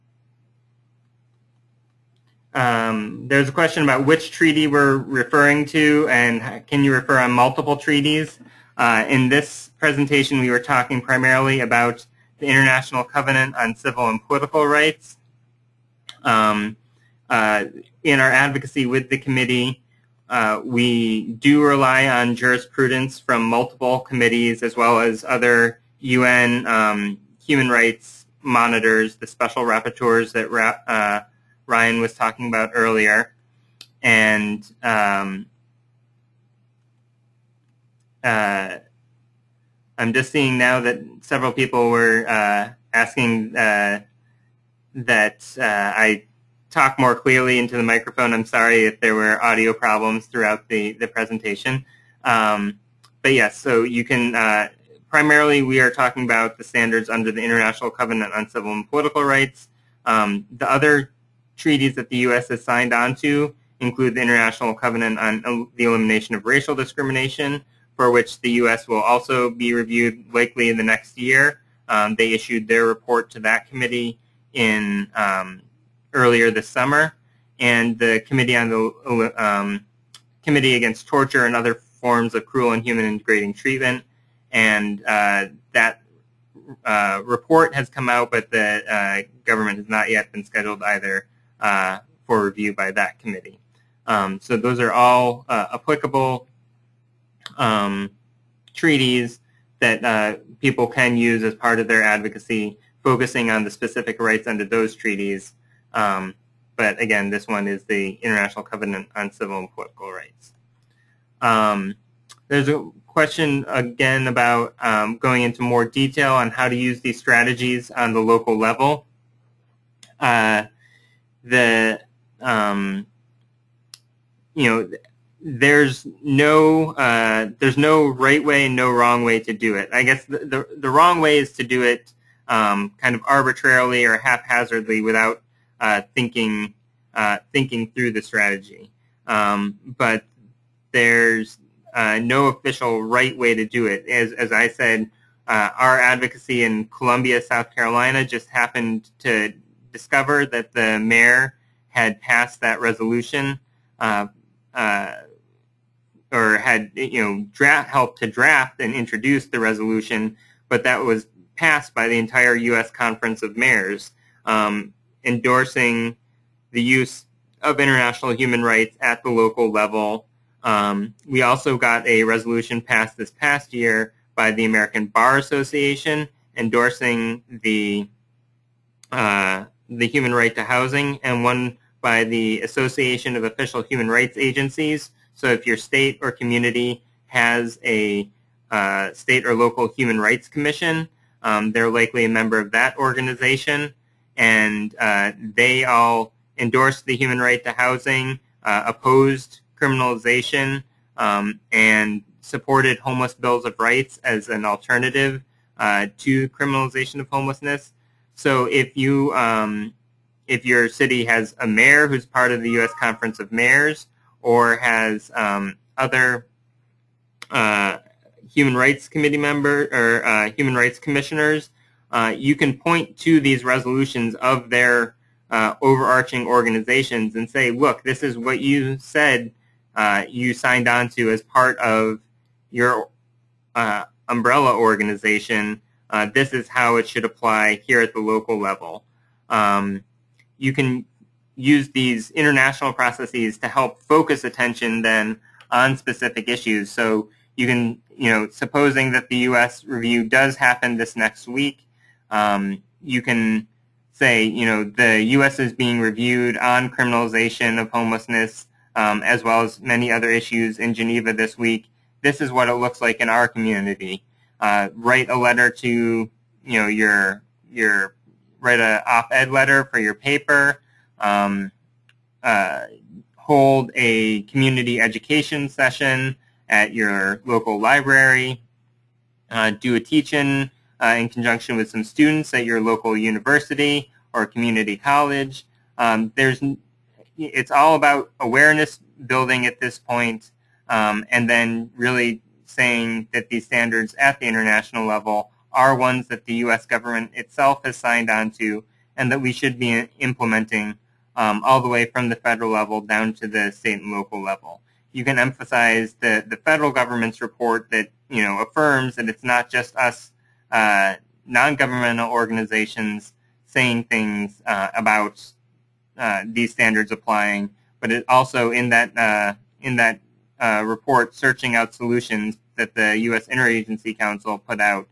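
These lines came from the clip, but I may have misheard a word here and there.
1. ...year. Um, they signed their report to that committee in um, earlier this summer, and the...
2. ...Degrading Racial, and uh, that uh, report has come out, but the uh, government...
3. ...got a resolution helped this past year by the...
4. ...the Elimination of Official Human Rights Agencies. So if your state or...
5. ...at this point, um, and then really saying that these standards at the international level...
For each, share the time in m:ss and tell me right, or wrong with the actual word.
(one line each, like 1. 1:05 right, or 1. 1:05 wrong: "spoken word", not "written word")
1. 1:11 wrong: "issued", not "signed"
2. 1:23 wrong: "Treatment", not "Racial"
3. 2:51 wrong: "passed", not "helped"
4. 3:02 wrong: "Association", not "Elimination"
5. 4:49 right.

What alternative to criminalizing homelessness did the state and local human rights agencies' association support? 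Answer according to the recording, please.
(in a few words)
homeless bills of rights.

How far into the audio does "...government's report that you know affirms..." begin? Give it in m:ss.
5:06.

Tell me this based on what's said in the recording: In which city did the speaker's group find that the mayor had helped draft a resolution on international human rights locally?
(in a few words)
Columbia, South Carolina.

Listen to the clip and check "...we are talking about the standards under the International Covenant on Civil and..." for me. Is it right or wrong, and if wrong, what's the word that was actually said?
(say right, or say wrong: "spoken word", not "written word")
right.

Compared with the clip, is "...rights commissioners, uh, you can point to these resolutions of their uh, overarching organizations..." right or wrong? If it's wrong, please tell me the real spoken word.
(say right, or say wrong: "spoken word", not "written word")
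right.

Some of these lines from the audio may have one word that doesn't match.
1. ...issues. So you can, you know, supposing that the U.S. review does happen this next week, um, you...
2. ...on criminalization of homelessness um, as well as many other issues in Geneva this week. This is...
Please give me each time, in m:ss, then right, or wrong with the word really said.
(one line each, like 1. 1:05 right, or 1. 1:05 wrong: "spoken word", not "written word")
1. 4:06 right
2. 4:16 right.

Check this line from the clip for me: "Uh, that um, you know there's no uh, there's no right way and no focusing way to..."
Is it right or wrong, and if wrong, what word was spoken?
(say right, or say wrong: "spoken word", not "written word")
wrong: "wrong", not "focusing".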